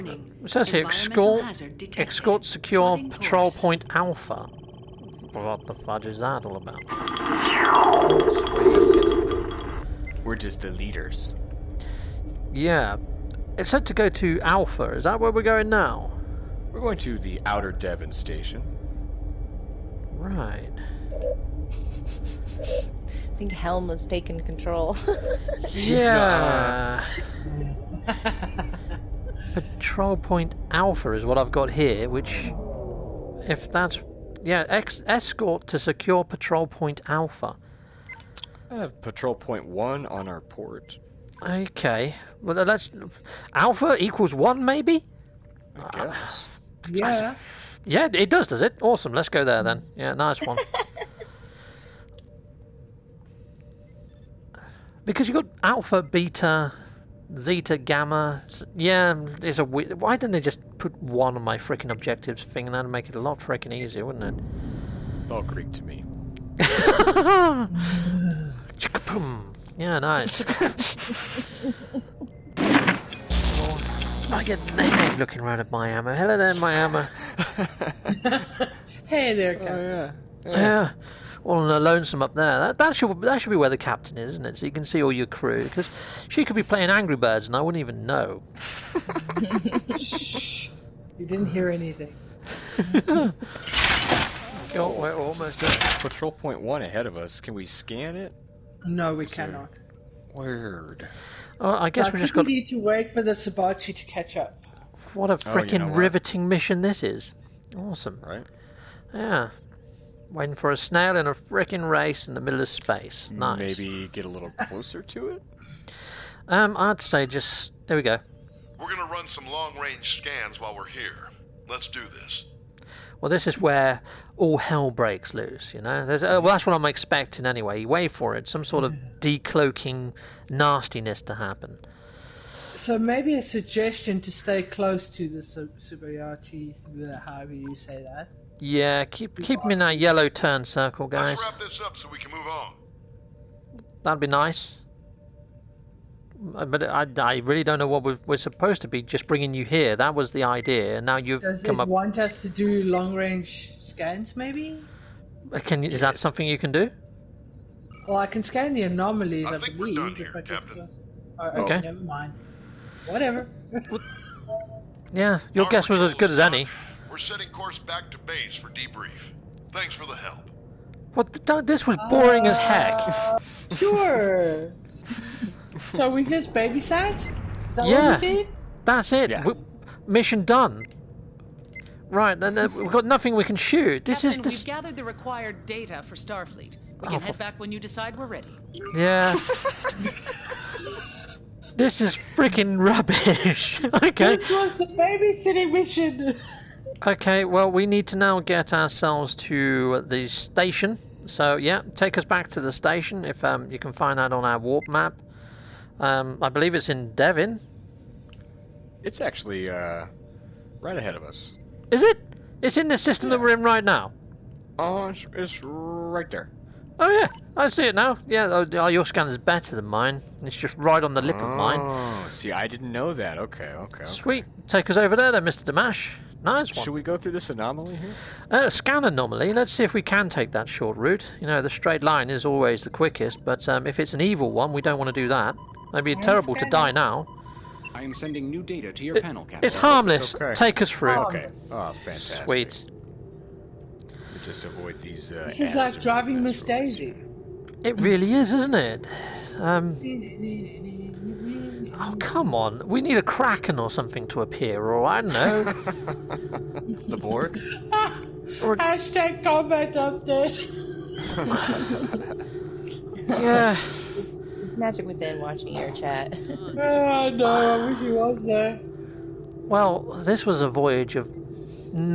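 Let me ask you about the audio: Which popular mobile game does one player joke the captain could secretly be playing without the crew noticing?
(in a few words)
Angry Birds.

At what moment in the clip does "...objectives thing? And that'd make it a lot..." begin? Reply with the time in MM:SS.
01:01.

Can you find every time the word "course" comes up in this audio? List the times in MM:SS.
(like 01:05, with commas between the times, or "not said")
00:03, 02:47.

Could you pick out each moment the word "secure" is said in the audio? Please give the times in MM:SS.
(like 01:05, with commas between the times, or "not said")
00:02, 00:35.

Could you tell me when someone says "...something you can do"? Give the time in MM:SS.
02:36.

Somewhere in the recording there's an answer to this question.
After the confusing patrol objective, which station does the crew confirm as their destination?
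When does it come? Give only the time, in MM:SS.
00:17.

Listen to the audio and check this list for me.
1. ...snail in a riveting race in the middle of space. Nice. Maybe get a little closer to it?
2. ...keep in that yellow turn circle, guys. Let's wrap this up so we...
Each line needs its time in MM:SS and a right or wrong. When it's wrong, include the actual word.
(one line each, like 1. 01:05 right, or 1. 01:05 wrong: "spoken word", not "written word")
1. 01:50 wrong: "freaking", not "riveting"
2. 02:19 right.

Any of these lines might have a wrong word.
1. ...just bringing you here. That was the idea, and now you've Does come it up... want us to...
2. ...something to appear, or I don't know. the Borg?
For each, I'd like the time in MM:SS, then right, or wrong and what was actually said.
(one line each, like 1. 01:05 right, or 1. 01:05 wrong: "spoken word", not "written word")
1. 02:29 right
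2. 04:13 right.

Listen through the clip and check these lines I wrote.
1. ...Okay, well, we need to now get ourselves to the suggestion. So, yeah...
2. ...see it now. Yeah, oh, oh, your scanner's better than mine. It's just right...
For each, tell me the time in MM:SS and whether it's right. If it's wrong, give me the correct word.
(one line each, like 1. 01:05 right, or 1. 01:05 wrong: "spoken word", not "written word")
1. 03:17 wrong: "station", not "suggestion"
2. 03:37 right.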